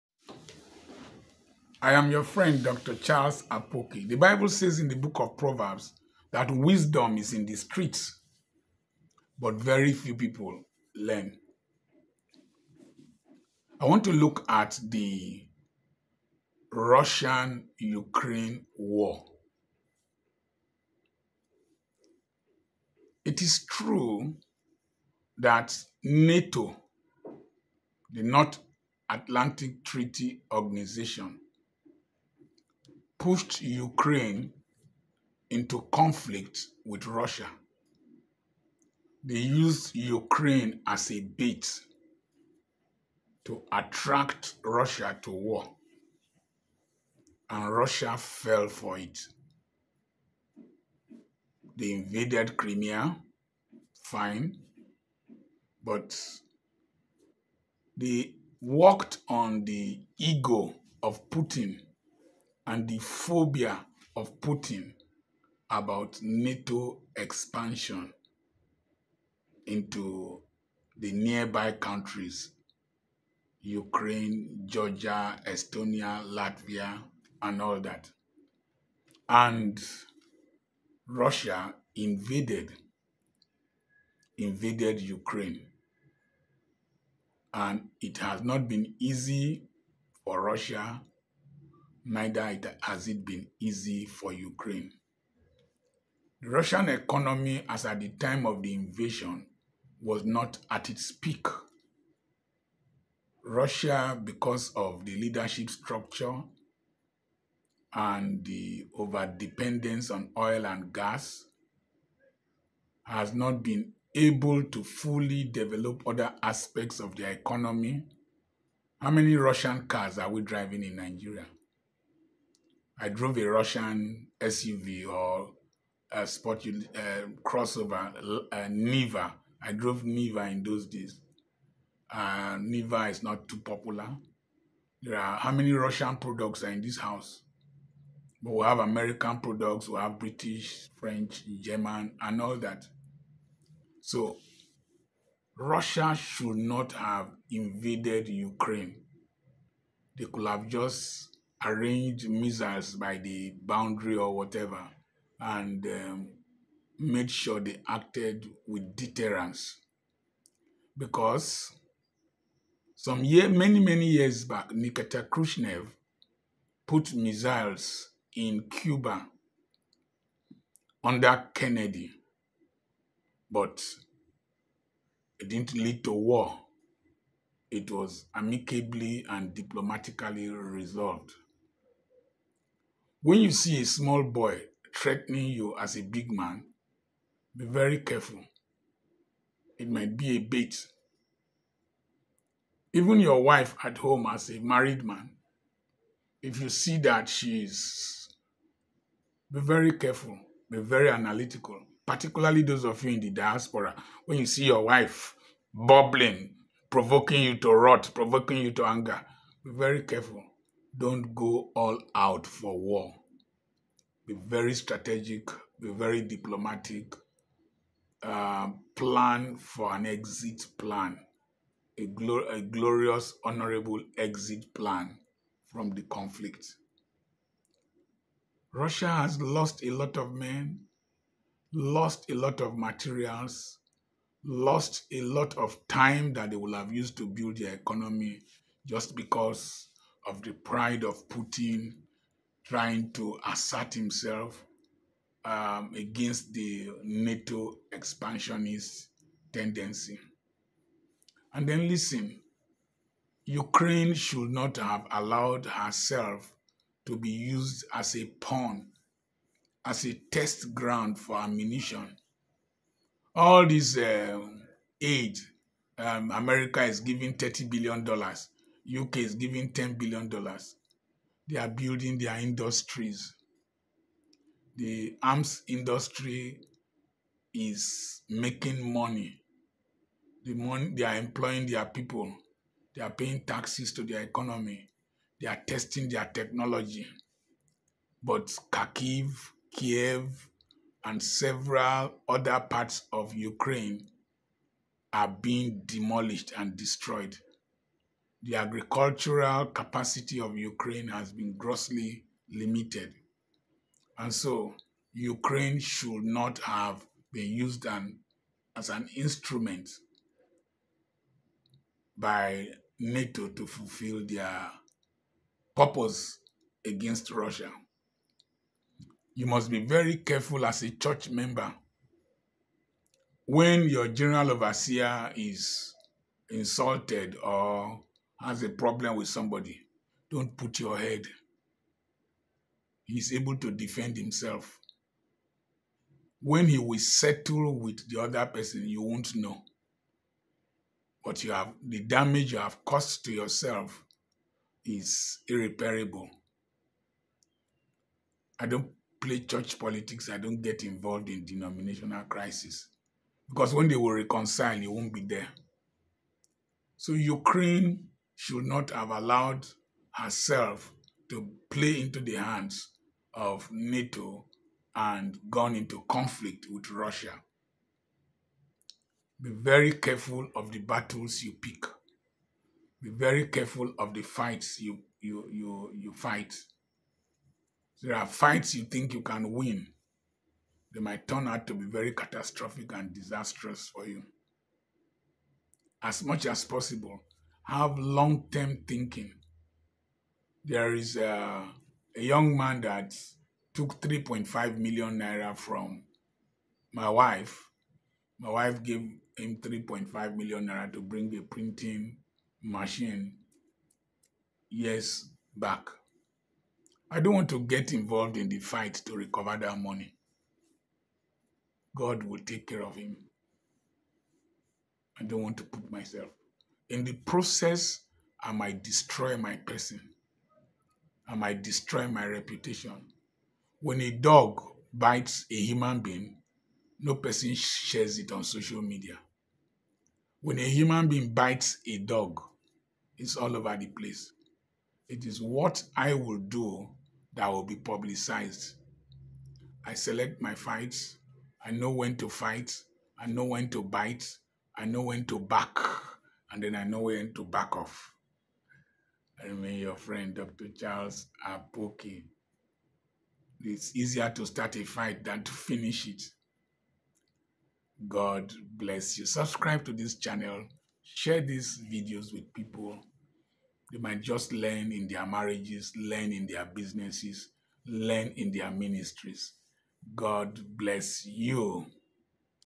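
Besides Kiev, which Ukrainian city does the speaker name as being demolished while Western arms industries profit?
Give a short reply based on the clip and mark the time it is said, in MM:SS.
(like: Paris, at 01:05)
Kharkiv, at 04:48.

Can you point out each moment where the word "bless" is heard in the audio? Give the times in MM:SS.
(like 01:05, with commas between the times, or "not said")
07:38, 07:50.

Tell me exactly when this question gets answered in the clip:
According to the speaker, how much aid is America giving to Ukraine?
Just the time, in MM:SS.
04:27.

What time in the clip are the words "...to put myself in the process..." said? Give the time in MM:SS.
06:55.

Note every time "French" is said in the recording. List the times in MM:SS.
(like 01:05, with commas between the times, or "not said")
02:20.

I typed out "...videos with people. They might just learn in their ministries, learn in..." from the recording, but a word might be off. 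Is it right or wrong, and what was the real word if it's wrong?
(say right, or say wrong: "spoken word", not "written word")
wrong: "marriages", not "ministries".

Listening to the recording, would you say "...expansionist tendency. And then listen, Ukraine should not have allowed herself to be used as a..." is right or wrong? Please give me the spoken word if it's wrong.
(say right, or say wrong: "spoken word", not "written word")
right.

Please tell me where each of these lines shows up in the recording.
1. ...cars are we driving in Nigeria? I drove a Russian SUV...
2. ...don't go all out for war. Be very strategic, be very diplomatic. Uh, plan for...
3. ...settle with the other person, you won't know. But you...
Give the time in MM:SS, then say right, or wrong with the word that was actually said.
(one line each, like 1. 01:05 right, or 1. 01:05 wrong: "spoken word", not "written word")
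1. 01:59 right
2. 03:30 right
3. 05:36 right.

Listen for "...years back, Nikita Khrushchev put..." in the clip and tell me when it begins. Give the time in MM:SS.
02:44.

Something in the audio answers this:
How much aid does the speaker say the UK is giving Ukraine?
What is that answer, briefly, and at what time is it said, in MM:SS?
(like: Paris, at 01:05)
$10 billion, at 04:29.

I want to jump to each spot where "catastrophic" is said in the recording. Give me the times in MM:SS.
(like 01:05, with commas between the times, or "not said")
06:22.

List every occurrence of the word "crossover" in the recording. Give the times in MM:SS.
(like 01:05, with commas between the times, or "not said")
02:07.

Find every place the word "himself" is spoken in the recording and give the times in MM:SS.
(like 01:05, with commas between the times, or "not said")
04:03, 05:34.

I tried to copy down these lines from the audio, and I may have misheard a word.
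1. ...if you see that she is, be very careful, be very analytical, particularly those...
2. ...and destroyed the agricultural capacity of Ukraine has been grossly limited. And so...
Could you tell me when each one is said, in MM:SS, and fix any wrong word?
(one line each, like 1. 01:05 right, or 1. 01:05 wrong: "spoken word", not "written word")
1. 03:16 right
2. 04:56 right.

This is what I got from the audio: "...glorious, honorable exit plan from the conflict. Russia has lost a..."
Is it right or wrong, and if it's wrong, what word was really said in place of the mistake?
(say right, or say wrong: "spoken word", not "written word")
right.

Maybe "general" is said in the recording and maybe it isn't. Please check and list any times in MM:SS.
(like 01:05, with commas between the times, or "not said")
05:24.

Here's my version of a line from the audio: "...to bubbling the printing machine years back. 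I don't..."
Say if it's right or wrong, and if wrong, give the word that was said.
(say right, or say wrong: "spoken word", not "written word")
wrong: "bring", not "bubbling".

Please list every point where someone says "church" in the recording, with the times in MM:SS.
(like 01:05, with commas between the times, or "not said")
05:20, 05:49.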